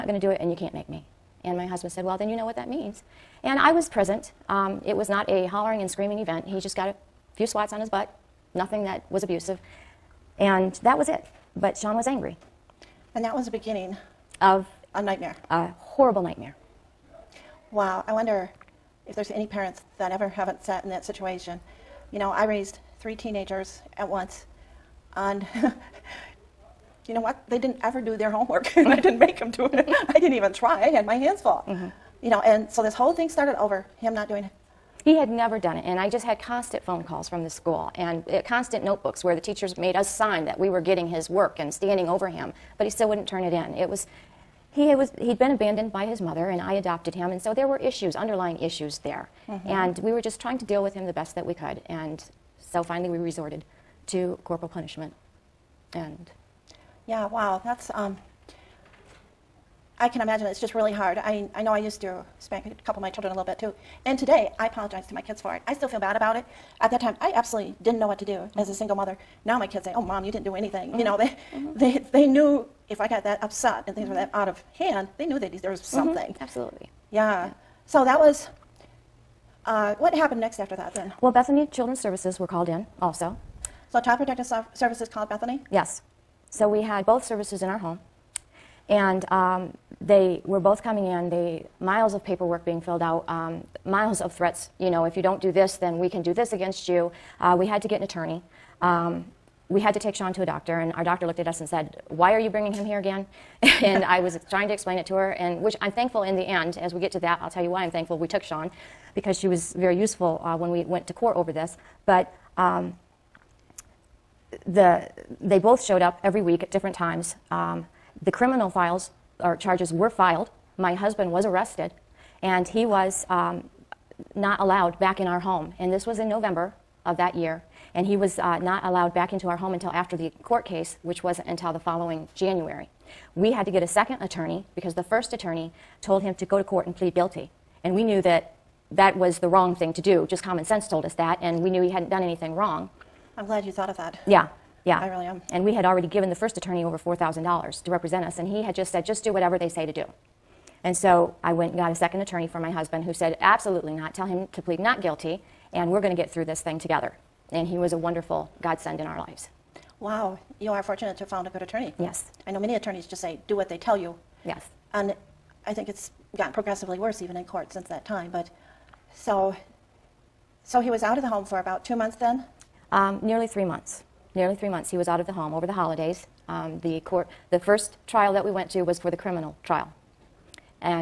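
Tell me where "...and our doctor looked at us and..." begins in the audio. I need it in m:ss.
1:40.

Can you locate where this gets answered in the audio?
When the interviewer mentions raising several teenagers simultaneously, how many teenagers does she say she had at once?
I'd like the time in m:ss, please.
0:22.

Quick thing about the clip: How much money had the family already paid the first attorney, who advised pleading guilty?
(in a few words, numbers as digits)
Over $4,000.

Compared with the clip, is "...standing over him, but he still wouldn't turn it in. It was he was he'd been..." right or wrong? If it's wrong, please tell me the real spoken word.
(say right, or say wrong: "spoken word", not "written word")
right.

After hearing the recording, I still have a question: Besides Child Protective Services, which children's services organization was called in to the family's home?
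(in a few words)
Bethany Children's Services.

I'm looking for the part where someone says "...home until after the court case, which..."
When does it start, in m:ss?
2:09.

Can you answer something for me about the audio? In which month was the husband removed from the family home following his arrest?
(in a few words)
November.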